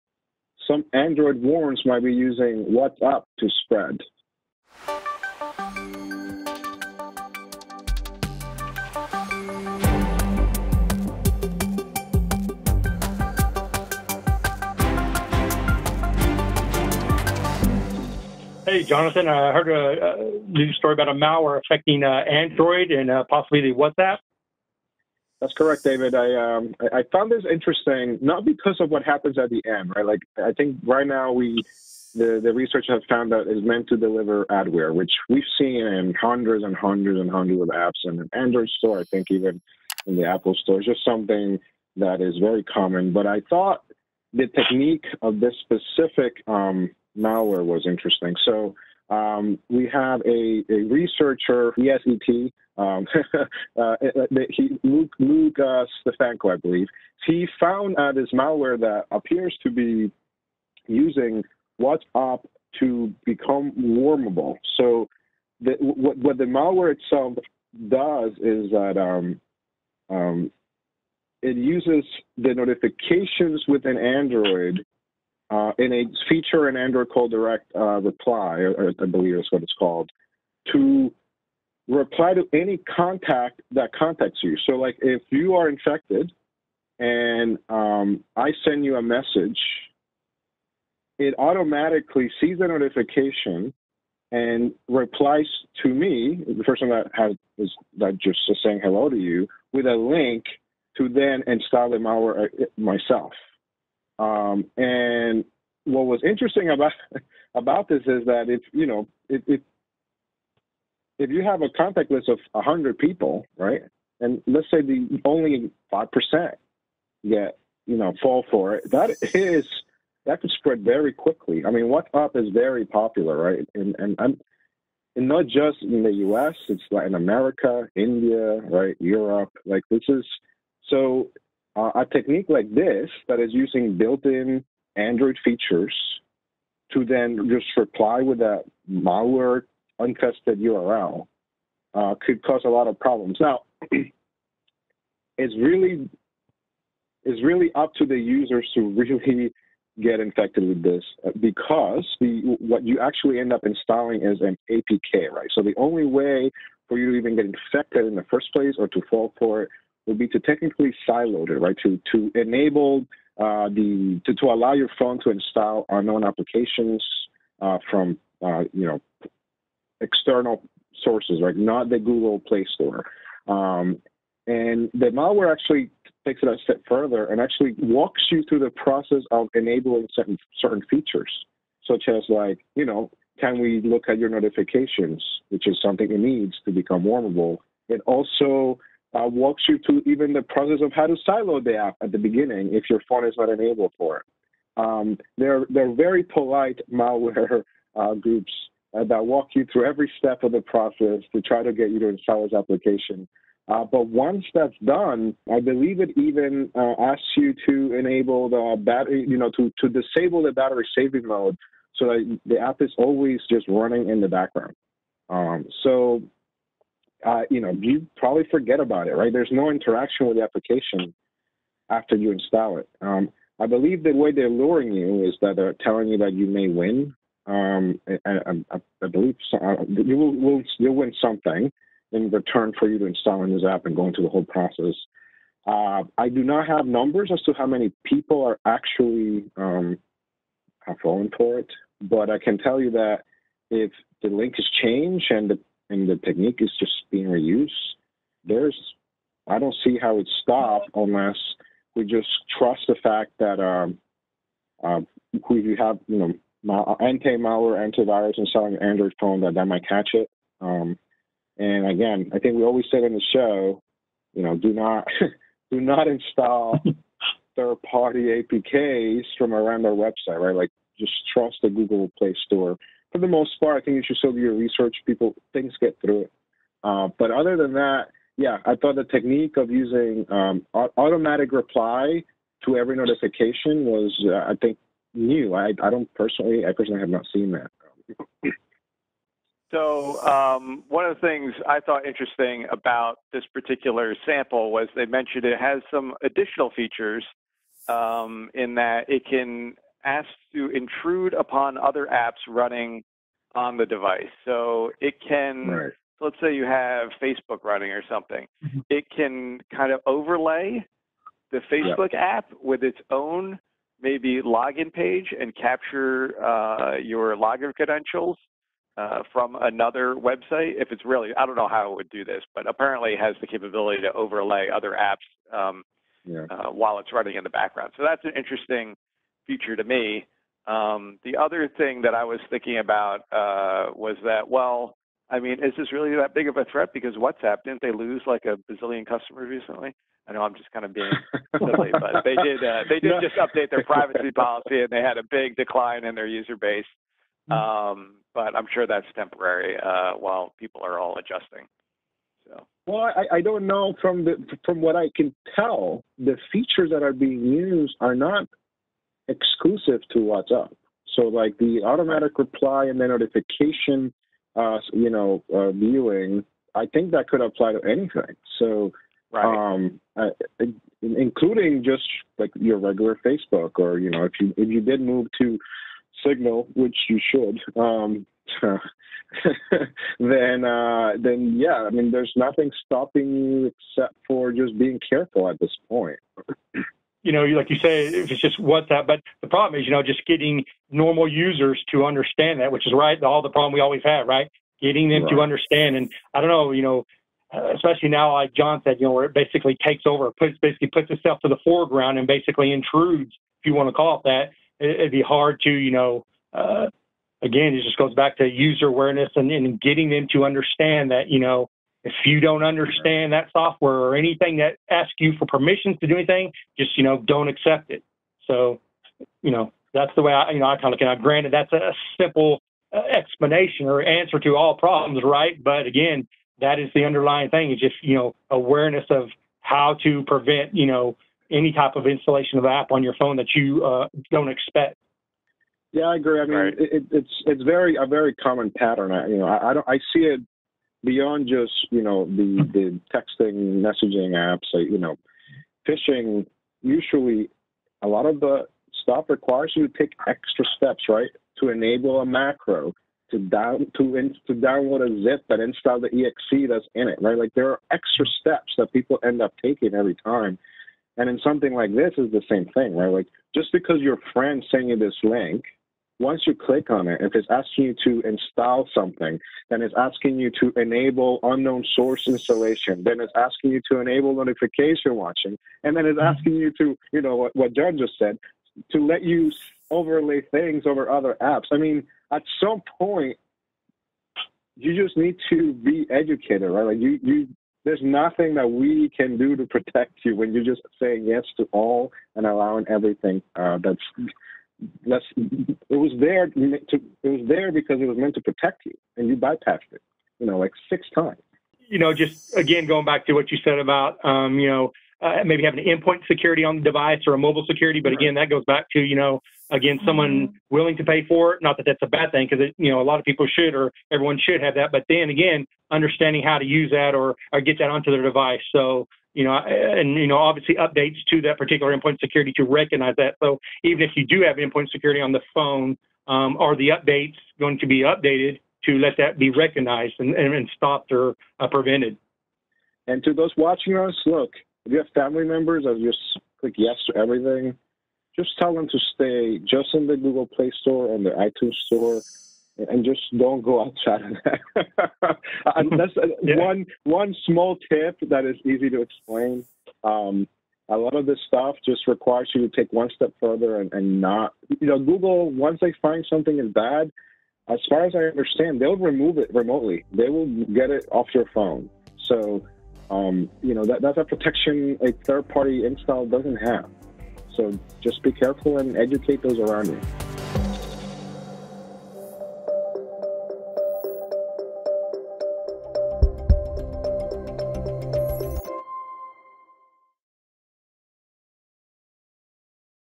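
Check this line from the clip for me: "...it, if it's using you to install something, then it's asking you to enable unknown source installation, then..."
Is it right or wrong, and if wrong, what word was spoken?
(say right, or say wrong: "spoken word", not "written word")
wrong: "asking", not "using".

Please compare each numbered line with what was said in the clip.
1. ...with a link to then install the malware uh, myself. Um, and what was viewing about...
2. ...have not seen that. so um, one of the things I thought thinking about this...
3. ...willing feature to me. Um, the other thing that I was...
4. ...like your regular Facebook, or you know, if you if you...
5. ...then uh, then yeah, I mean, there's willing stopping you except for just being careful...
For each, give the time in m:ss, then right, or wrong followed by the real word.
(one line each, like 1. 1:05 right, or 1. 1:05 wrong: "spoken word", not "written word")
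1. 1:39 wrong: "interesting", not "viewing"
2. 4:46 wrong: "interesting", not "thinking"
3. 5:28 wrong: "interesting", not "willing"
4. 6:12 right
5. 6:18 wrong: "nothing", not "willing".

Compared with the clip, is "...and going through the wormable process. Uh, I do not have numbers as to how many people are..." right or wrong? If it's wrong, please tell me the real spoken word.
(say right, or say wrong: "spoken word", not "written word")
wrong: "whole", not "wormable".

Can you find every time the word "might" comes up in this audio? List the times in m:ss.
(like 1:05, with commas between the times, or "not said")
0:01, 4:19.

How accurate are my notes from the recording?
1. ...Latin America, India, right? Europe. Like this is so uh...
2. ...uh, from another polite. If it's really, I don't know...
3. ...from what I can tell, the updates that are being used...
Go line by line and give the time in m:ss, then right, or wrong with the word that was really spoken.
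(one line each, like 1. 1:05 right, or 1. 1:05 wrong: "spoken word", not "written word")
1. 2:06 right
2. 5:18 wrong: "website", not "polite"
3. 5:54 wrong: "features", not "updates".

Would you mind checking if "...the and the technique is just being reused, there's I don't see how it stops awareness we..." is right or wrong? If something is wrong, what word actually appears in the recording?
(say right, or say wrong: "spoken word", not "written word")
wrong: "unless", not "awareness".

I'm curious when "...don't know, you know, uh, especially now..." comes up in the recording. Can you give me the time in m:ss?
6:36.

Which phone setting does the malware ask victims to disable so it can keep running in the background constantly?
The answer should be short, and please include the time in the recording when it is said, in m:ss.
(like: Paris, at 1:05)
battery saving mode, at 3:30.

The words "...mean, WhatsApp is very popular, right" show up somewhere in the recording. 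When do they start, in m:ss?
2:01.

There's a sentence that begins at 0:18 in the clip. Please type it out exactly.
Hey, Jonathan, I heard a, a story about a malware affecting uh, Android and uh, possibly the WhatsApp.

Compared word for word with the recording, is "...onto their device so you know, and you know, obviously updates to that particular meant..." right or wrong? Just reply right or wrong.
wrong.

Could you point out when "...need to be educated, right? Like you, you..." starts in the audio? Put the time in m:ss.
8:05.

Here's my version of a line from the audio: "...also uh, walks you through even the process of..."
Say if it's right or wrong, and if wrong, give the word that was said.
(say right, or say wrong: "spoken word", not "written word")
right.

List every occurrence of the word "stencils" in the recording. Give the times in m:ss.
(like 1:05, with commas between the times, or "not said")
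not said.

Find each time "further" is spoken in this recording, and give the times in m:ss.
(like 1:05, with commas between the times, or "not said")
2:56, 9:13.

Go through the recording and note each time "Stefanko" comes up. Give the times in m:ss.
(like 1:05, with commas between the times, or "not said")
0:56.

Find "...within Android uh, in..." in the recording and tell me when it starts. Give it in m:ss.
1:13.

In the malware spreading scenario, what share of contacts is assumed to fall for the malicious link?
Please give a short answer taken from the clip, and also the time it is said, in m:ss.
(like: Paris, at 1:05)
5%, at 1:55.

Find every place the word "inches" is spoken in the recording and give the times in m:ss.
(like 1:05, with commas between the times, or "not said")
not said.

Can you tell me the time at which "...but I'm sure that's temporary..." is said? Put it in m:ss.
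5:48.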